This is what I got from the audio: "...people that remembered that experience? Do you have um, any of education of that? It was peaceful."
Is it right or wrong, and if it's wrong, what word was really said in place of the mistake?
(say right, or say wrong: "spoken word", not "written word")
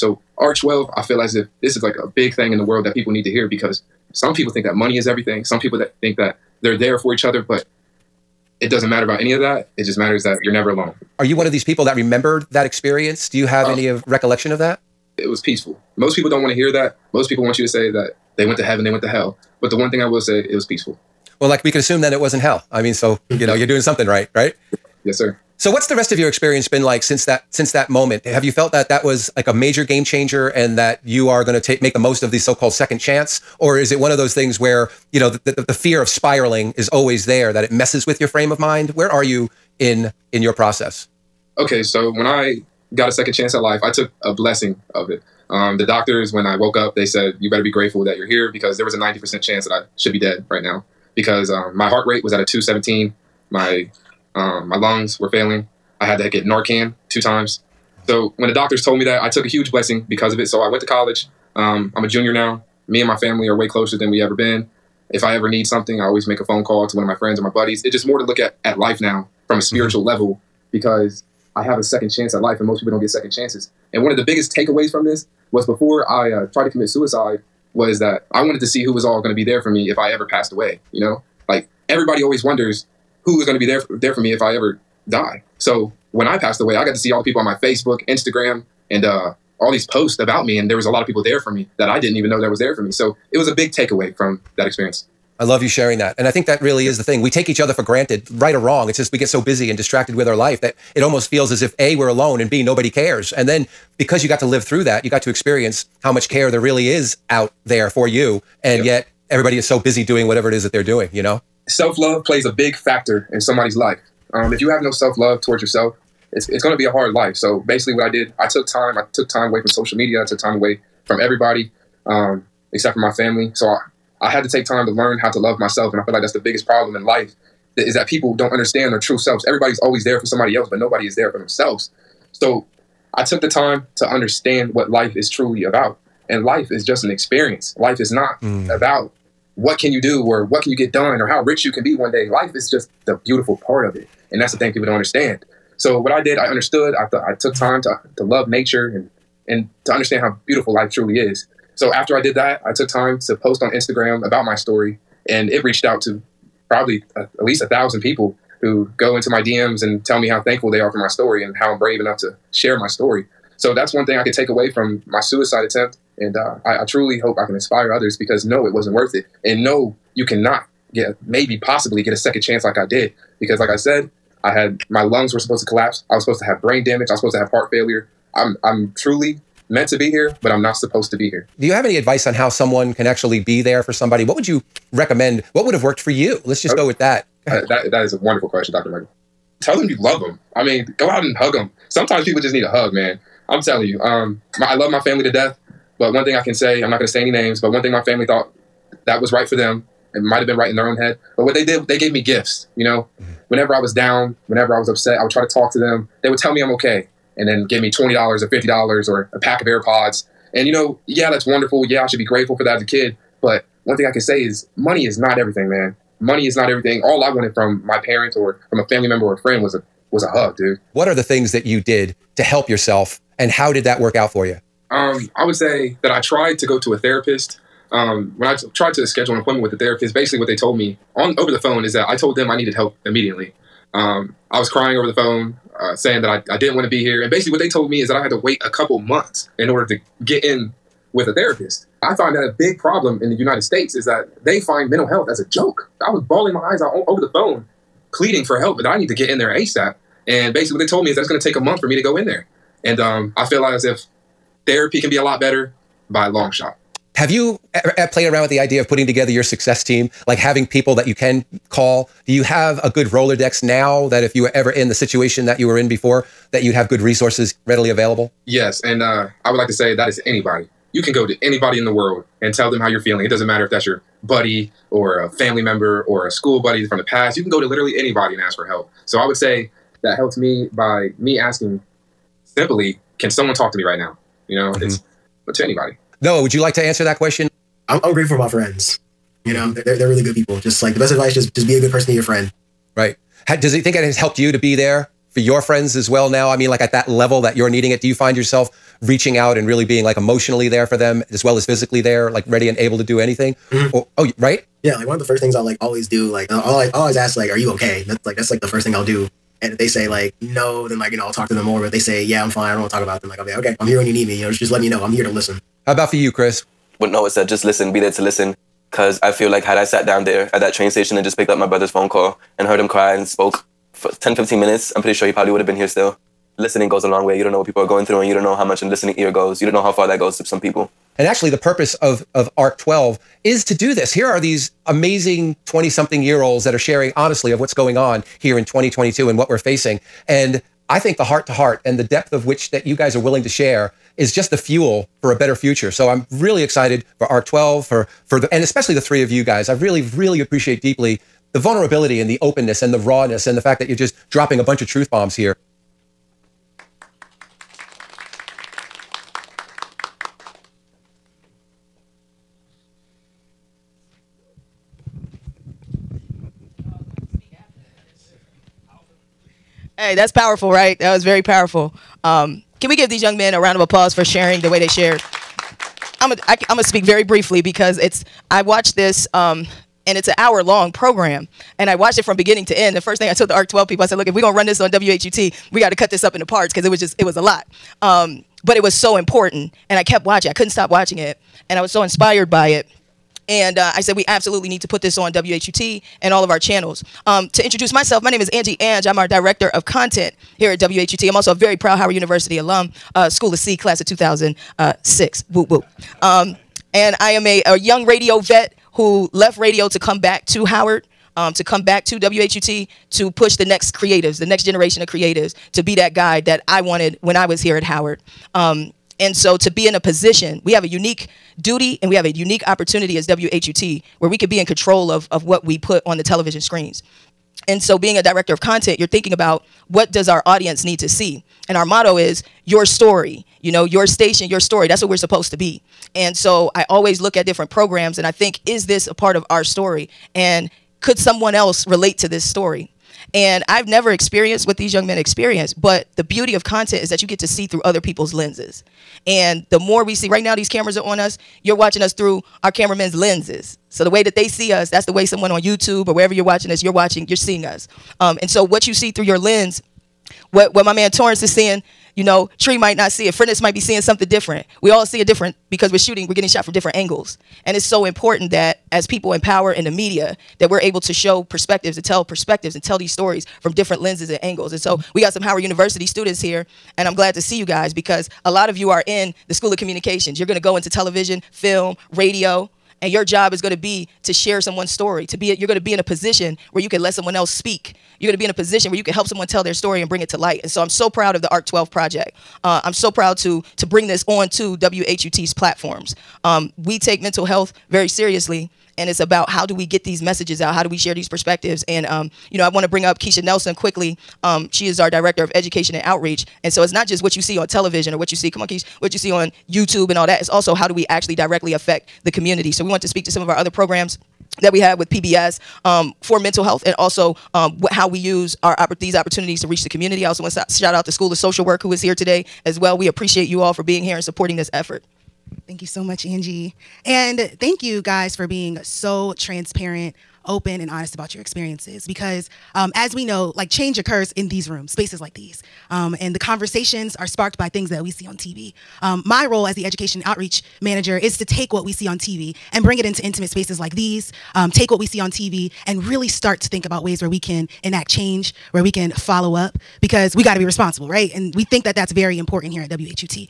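wrong: "recollection", not "education".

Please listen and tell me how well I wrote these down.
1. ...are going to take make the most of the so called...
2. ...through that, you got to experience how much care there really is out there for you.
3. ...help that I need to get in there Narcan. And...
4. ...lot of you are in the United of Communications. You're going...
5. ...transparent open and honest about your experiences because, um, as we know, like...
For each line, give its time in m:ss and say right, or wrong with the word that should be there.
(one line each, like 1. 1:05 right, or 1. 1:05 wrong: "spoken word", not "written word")
1. 0:31 right
2. 1:44 right
3. 4:08 wrong: "ASAP", not "Narcan"
4. 7:58 wrong: "School", not "United"
5. 8:49 right.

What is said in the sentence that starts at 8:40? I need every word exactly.
I also want to shout out the School of Social Work who is here today as well.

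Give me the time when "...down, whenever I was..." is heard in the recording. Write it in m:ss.
3:23.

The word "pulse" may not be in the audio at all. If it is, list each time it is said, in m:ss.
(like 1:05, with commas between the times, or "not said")
not said.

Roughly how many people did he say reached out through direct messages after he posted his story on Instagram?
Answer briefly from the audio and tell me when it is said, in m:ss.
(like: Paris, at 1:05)
at least 1000, at 2:37.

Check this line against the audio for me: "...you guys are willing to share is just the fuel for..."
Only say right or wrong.
right.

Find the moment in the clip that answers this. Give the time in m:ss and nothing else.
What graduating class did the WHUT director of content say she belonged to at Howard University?
6:43.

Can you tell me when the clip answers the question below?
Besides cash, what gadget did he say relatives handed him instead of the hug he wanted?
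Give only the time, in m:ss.
3:29.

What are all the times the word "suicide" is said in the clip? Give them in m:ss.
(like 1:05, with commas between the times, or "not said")
1:16, 2:45.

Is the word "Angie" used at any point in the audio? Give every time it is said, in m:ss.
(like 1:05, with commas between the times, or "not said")
6:38, 8:46.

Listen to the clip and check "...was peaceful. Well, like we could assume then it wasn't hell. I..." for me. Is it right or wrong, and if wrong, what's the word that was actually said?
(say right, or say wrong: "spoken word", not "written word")
right.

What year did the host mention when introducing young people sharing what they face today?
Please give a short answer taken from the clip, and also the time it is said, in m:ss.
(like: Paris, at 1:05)
2022, at 5:38.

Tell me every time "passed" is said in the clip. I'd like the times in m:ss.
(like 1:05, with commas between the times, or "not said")
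1:20, 1:26.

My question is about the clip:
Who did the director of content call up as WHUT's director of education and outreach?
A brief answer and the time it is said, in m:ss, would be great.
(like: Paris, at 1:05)
Keisha Nelson, at 8:23.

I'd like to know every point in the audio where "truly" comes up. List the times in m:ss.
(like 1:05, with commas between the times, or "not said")
2:15, 2:30, 2:46, 2:58.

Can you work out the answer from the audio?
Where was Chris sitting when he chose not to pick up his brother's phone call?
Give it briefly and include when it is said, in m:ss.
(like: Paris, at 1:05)
train station, at 5:20.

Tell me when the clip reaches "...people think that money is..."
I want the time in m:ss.
0:04.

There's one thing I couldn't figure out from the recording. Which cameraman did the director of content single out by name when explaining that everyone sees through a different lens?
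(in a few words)
Torrance.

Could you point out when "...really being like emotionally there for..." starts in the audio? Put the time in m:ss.
4:59.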